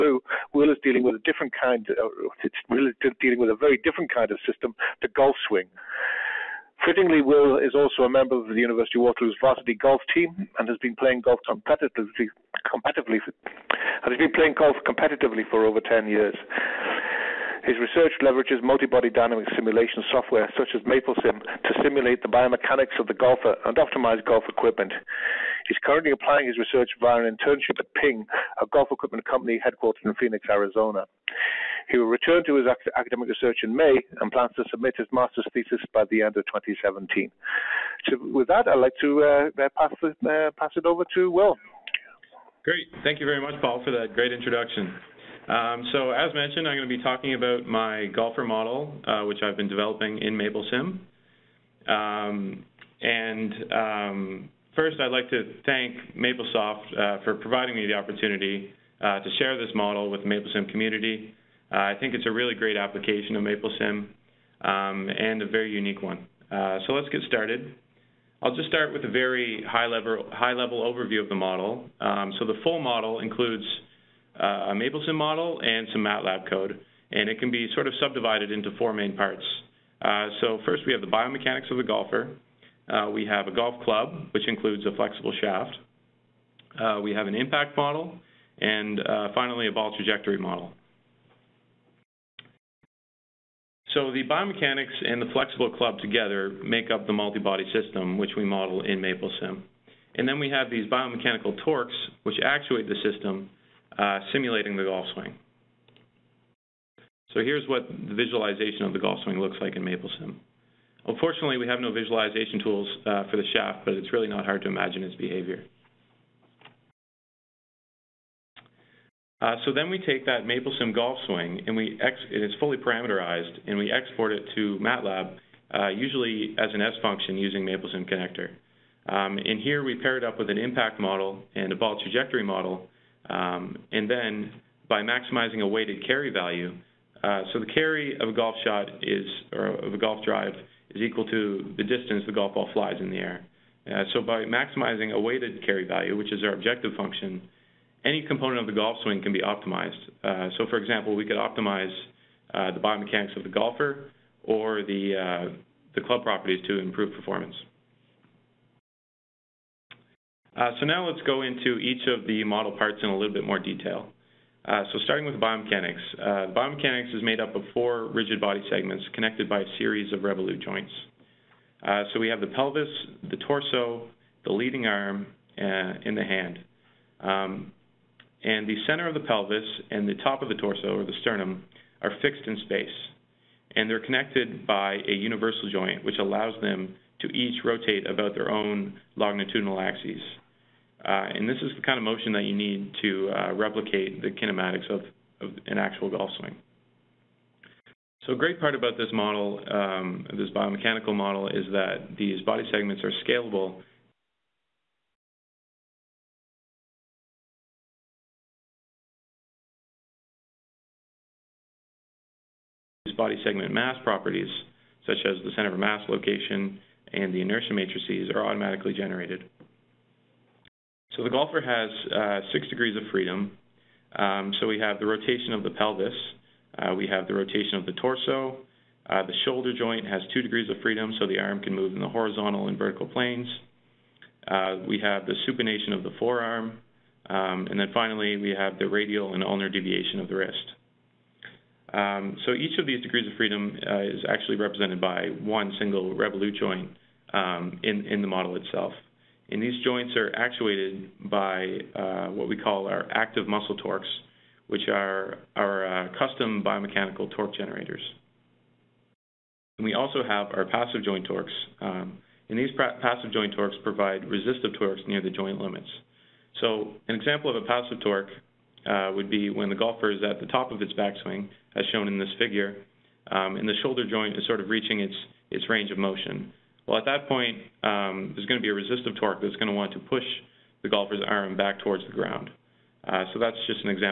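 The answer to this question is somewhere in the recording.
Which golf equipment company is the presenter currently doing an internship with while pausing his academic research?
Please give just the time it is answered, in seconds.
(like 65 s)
27 s.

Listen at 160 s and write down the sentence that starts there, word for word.
Uh, so now let's go into each of the model parts in a little bit more detail.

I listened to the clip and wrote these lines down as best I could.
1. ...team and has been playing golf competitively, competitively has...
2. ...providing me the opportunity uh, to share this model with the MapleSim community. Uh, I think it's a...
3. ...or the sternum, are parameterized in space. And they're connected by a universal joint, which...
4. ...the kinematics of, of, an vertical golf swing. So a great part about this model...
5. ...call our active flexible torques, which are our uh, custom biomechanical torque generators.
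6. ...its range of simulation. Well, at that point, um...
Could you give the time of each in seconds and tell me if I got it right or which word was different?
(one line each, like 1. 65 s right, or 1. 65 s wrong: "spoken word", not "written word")
1. 10 s right
2. 57 s right
3. 180 s wrong: "fixed", not "parameterized"
4. 194 s wrong: "actual", not "vertical"
5. 252 s wrong: "muscle", not "flexible"
6. 275 s wrong: "motion", not "simulation".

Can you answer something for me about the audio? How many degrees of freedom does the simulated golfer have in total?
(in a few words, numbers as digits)
6.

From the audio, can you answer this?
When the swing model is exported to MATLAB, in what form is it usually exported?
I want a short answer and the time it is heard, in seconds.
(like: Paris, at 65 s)
S function, at 126 s.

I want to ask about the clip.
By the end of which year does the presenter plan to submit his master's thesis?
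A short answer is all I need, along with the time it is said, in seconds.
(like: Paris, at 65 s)
2017, at 36 s.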